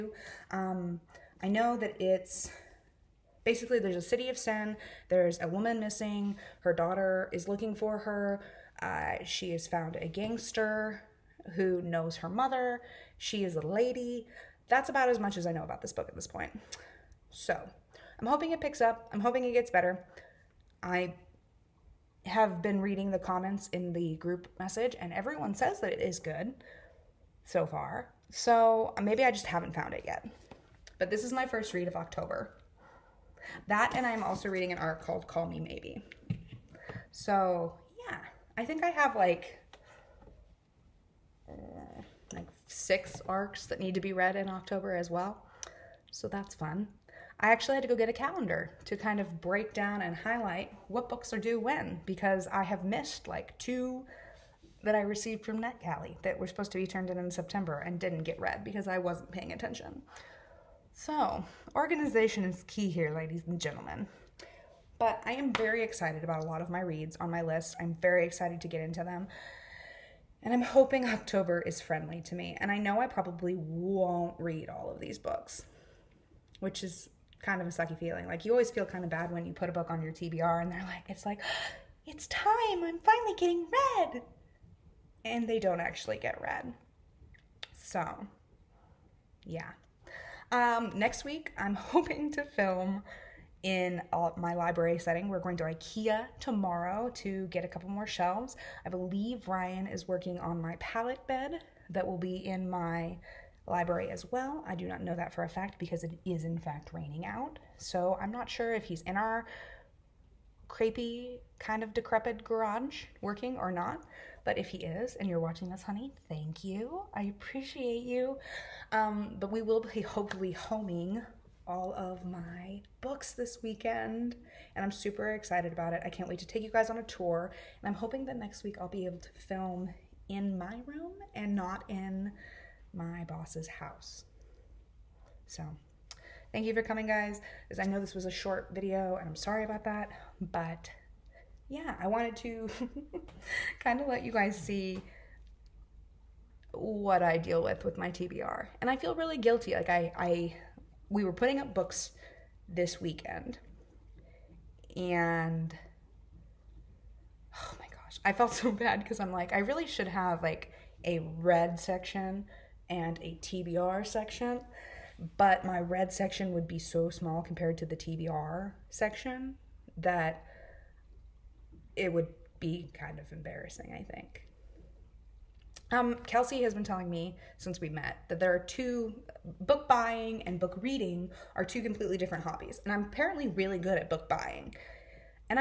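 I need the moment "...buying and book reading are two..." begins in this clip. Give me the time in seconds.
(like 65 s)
179 s.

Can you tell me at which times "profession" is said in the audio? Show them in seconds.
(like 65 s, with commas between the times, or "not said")
not said.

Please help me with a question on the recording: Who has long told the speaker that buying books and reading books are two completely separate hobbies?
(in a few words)
Kelsey.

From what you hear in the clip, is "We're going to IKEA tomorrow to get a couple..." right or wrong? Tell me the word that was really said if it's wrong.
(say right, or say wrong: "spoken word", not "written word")
right.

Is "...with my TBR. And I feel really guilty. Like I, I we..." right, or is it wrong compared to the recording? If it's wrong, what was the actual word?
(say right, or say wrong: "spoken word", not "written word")
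right.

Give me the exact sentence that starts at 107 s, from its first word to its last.
So I'm not sure if he's in our crepey kind of decrepit garage working or not.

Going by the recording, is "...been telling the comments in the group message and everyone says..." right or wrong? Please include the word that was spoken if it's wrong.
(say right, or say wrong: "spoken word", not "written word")
wrong: "reading", not "telling".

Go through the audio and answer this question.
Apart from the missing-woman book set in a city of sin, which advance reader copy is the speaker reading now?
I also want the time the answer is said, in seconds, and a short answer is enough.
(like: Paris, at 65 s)
Call Me Maybe, at 35 s.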